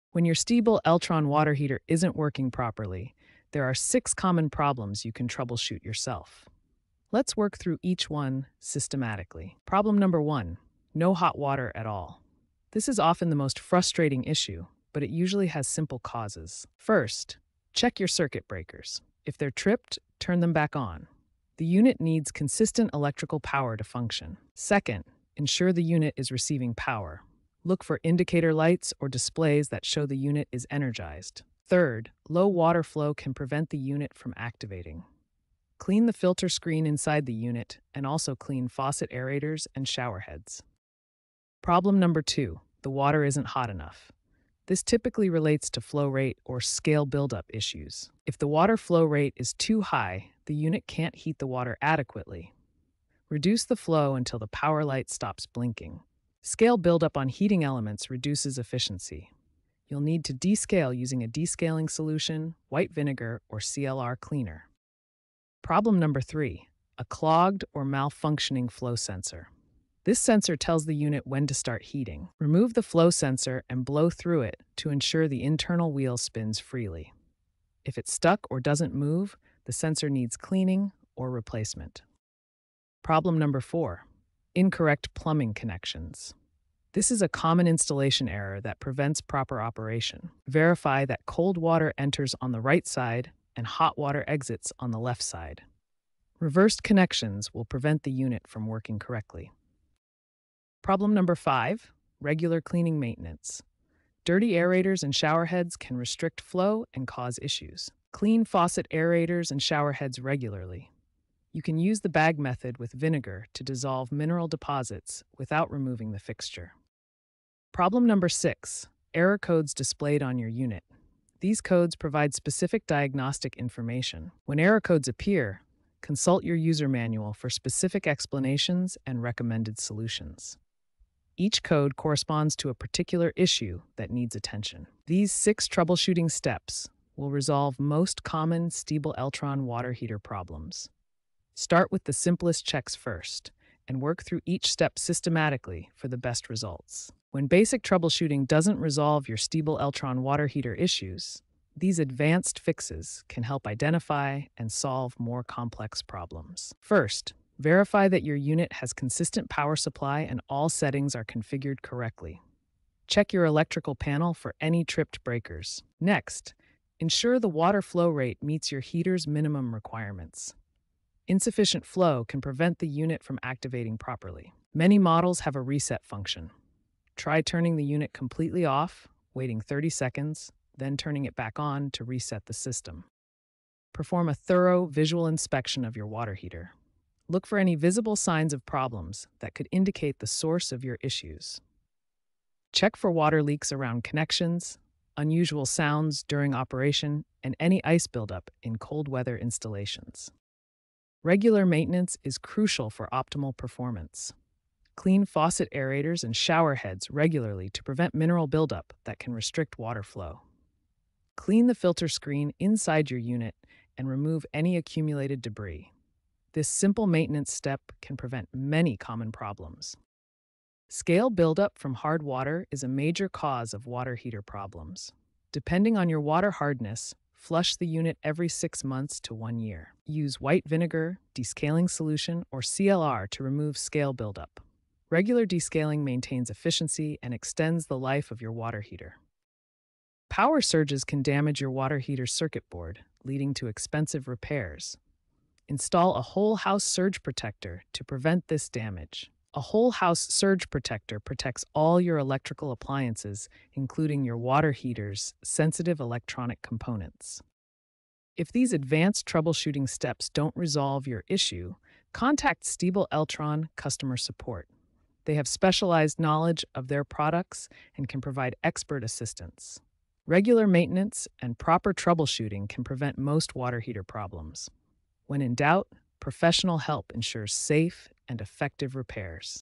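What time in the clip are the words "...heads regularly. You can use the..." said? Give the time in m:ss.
1:49.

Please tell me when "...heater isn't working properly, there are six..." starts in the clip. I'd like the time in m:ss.
0:01.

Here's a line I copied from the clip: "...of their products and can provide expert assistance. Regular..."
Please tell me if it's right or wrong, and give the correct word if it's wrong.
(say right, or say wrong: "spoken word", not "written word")
right.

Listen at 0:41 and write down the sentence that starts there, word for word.
Problem number two, the water isn't hot enough.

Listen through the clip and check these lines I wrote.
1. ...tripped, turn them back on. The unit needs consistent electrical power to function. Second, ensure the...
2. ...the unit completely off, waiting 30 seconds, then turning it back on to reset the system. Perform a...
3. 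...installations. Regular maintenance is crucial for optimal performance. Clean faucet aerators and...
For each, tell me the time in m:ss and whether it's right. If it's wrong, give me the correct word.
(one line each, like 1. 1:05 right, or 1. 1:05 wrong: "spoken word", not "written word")
1. 0:19 right
2. 2:57 right
3. 3:19 right.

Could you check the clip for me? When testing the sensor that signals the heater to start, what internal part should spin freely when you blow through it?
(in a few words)
Wheel.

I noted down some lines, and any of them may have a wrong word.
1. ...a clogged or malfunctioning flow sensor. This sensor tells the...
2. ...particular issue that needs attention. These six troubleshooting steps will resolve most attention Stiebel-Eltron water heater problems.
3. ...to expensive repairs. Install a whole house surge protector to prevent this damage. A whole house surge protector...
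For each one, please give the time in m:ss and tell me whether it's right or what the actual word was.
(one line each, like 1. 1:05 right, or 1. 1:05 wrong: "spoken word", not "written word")
1. 1:06 right
2. 2:12 wrong: "common", not "attention"
3. 4:03 right.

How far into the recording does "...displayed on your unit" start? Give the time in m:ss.
1:59.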